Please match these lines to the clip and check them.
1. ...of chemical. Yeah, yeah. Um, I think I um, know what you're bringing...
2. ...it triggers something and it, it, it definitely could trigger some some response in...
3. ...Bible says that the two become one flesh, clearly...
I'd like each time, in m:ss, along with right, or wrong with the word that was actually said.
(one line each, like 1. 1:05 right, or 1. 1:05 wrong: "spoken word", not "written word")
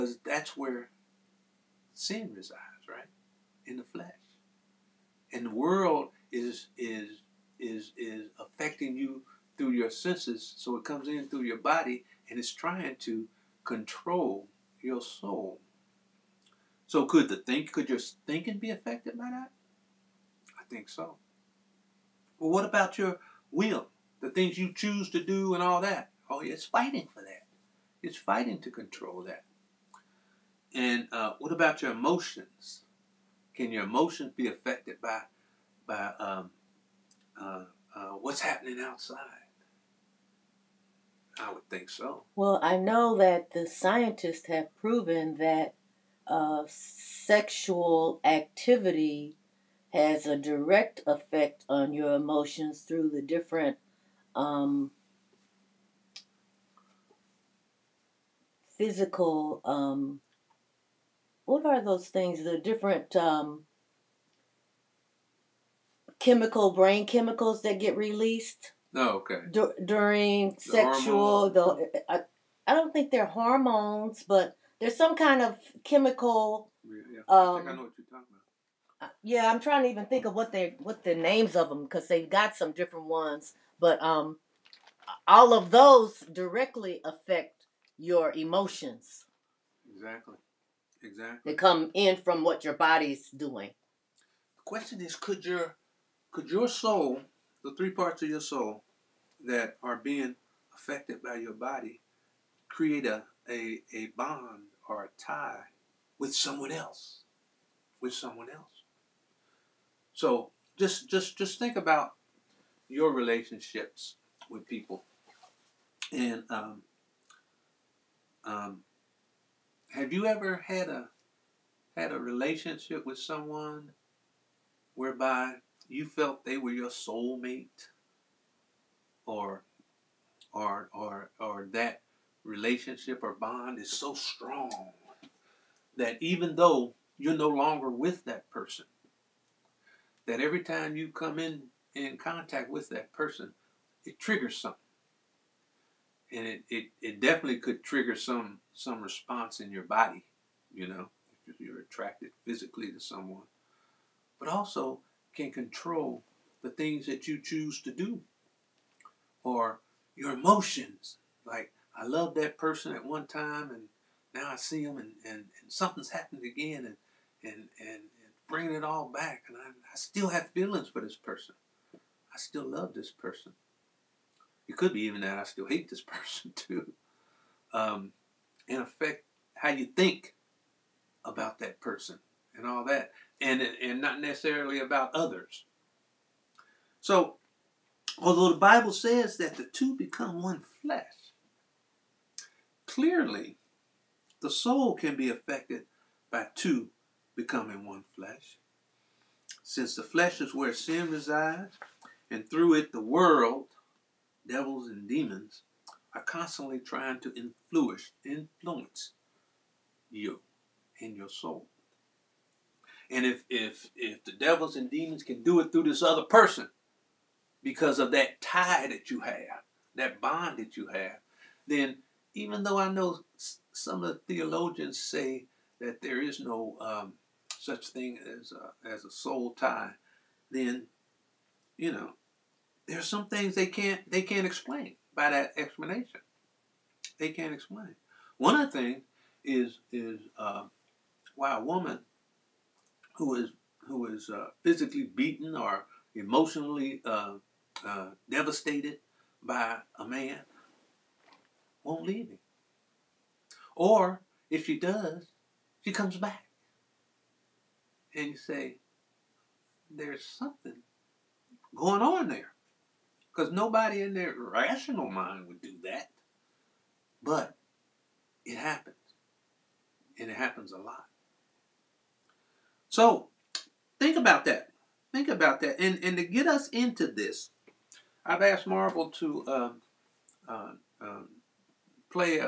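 1. 1:15 wrong: "talking", not "bringing"
2. 2:24 right
3. 3:08 right.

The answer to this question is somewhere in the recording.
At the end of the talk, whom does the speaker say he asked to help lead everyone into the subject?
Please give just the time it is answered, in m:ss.
4:38.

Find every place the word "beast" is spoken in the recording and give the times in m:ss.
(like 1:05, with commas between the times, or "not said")
not said.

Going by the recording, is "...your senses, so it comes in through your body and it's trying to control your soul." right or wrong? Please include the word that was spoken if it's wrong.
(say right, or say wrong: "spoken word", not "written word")
right.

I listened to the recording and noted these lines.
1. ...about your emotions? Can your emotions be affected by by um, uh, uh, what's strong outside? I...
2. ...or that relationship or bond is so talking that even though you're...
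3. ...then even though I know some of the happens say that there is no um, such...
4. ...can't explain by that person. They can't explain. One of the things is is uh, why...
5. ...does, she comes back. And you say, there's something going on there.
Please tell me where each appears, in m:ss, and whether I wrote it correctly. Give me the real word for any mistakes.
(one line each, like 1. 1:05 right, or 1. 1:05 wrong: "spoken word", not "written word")
1. 0:31 wrong: "happening", not "strong"
2. 2:11 wrong: "strong", not "talking"
3. 3:41 wrong: "theologians", not "happens"
4. 3:54 wrong: "explanation", not "person"
5. 4:14 right.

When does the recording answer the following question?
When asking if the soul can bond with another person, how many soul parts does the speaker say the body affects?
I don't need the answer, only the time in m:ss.
1:37.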